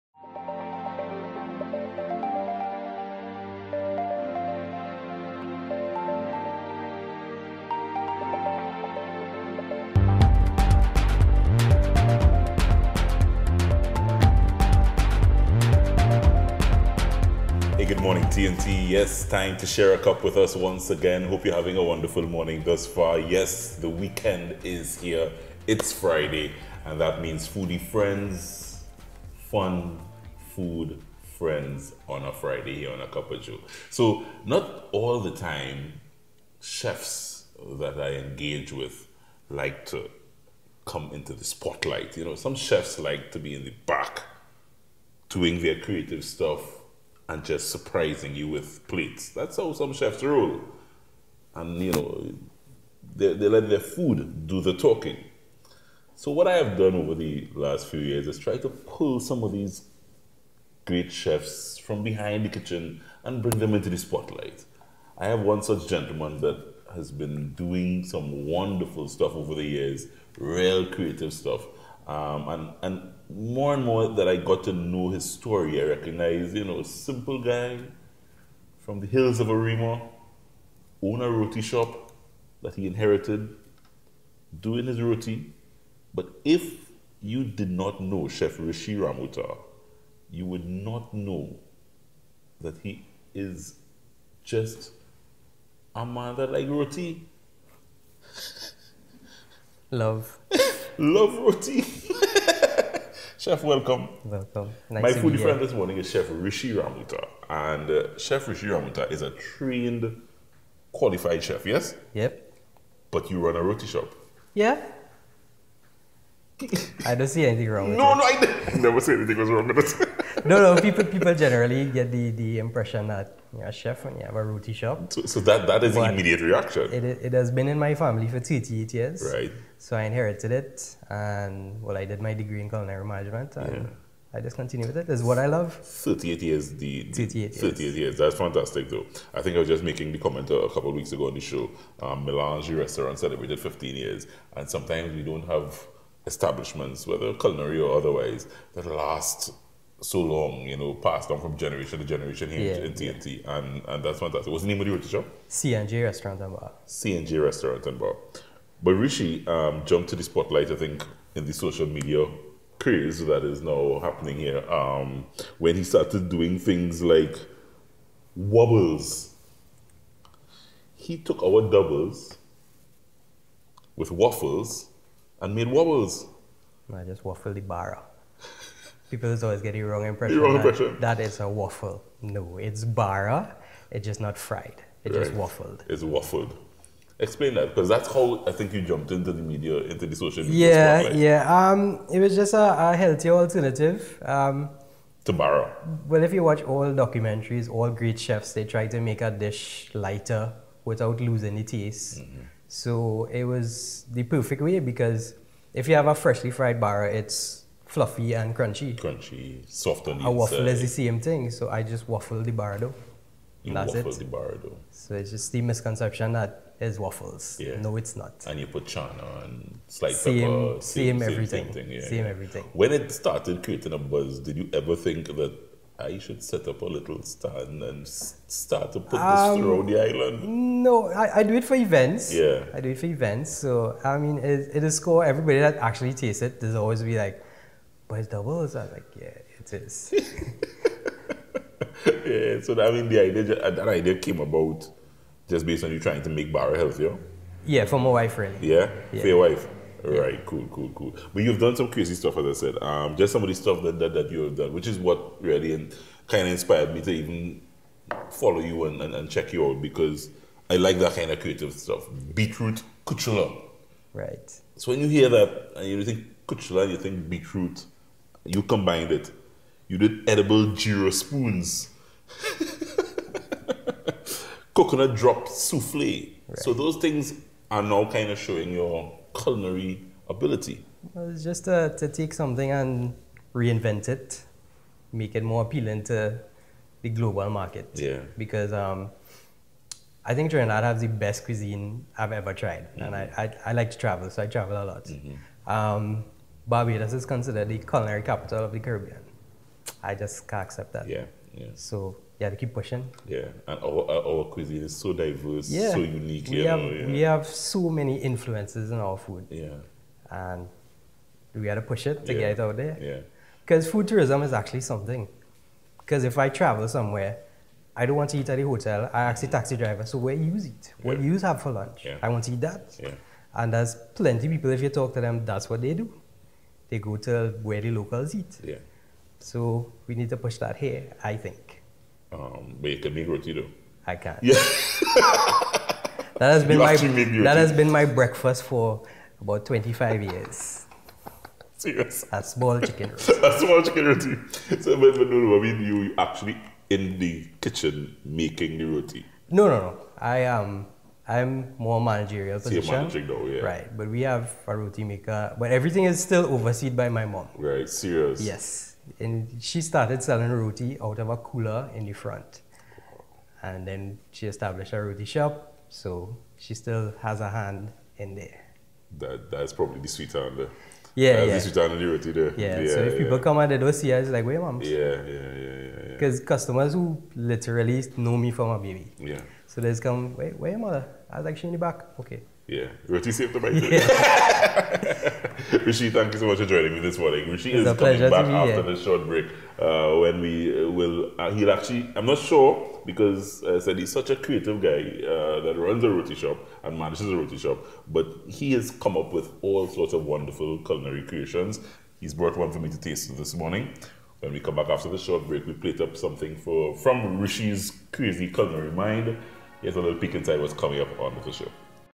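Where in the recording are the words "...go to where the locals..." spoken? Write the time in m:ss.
5:26.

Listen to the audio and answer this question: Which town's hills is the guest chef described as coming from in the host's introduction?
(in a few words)
Arima.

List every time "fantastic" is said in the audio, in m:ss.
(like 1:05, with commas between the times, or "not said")
2:18, 2:34.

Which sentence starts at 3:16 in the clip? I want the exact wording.
Well, if you watch all documentaries, all great chefs, they try to make a dish lighter without losing the taste.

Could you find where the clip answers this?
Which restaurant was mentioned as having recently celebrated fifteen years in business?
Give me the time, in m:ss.
2:22.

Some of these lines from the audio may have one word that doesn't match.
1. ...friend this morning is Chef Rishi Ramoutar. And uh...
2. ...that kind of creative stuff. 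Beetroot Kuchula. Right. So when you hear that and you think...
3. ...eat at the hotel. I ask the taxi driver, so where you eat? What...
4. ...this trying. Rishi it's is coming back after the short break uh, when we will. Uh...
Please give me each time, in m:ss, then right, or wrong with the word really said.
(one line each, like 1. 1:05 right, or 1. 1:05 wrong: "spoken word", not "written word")
1. 1:45 right
2. 4:20 right
3. 5:18 right
4. 6:26 wrong: "morning", not "trying".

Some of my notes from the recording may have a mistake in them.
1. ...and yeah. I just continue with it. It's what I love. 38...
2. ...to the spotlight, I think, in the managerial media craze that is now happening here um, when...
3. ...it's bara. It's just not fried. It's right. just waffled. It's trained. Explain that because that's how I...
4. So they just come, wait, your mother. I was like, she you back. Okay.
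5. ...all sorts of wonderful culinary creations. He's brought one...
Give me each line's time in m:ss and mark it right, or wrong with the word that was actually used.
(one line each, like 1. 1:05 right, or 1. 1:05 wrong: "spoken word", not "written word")
1. 2:13 right
2. 2:40 wrong: "social", not "managerial"
3. 3:02 wrong: "waffled", not "trained"
4. 6:19 right
5. 6:39 right.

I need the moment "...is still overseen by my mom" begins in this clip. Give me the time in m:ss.
5:56.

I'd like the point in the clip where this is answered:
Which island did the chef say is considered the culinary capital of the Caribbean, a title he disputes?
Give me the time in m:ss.
4:56.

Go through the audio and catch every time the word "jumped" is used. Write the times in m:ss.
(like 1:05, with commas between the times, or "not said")
2:39, 3:08.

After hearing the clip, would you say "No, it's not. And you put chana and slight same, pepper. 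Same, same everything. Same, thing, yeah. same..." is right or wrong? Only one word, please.
right.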